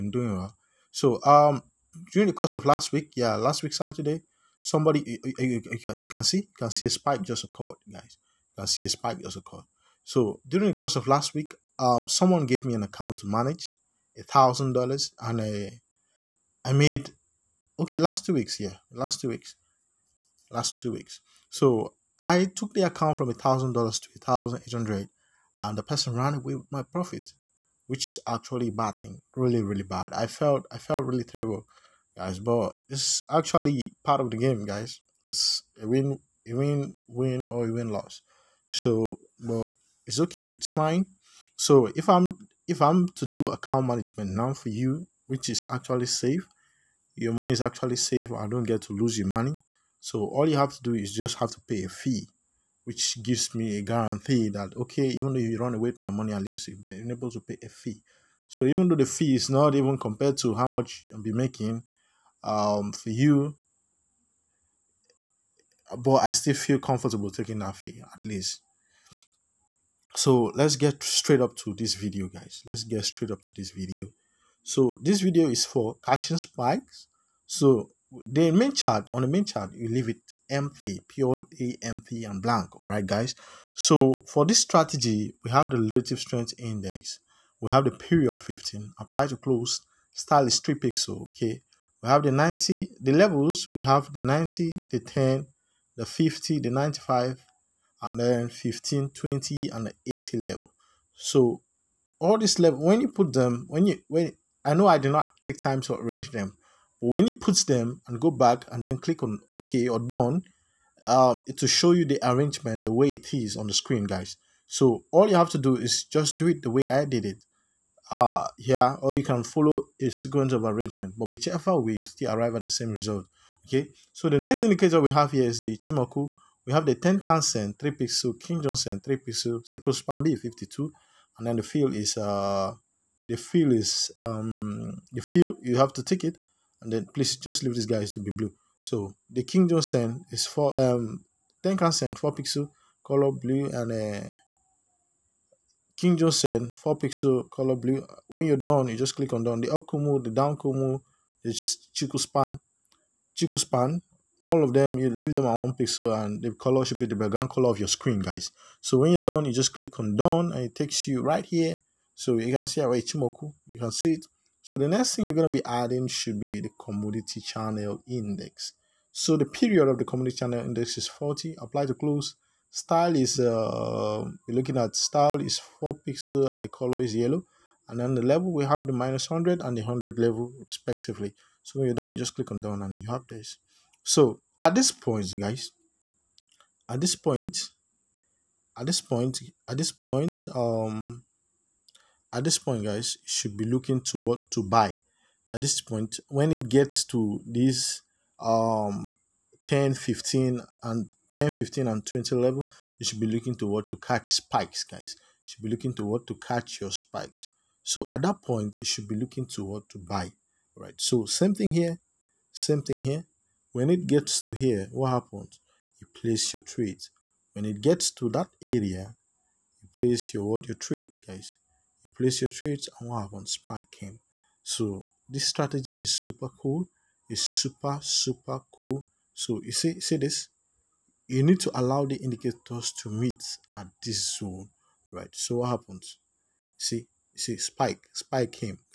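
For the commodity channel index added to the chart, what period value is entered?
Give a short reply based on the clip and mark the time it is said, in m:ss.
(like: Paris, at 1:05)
40, at 2:51.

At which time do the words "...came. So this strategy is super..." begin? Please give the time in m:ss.
3:43.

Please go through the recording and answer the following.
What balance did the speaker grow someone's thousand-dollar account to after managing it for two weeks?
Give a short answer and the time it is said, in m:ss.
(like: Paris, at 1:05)
$1,800, at 0:24.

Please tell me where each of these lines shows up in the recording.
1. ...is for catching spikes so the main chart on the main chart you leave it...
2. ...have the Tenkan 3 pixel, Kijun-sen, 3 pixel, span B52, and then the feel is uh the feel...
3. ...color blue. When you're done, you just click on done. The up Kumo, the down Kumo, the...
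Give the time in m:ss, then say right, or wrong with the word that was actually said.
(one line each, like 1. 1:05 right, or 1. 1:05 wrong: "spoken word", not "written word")
1. 1:15 right
2. 2:06 right
3. 2:27 right.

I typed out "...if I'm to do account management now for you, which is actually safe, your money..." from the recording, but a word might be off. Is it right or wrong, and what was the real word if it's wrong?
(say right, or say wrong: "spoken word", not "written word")
right.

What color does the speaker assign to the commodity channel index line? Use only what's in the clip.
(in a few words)
Yellow.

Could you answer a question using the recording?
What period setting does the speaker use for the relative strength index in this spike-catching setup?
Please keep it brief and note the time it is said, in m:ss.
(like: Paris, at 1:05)
15, at 1:27.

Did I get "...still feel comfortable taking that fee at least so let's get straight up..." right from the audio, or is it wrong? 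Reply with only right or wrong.
right.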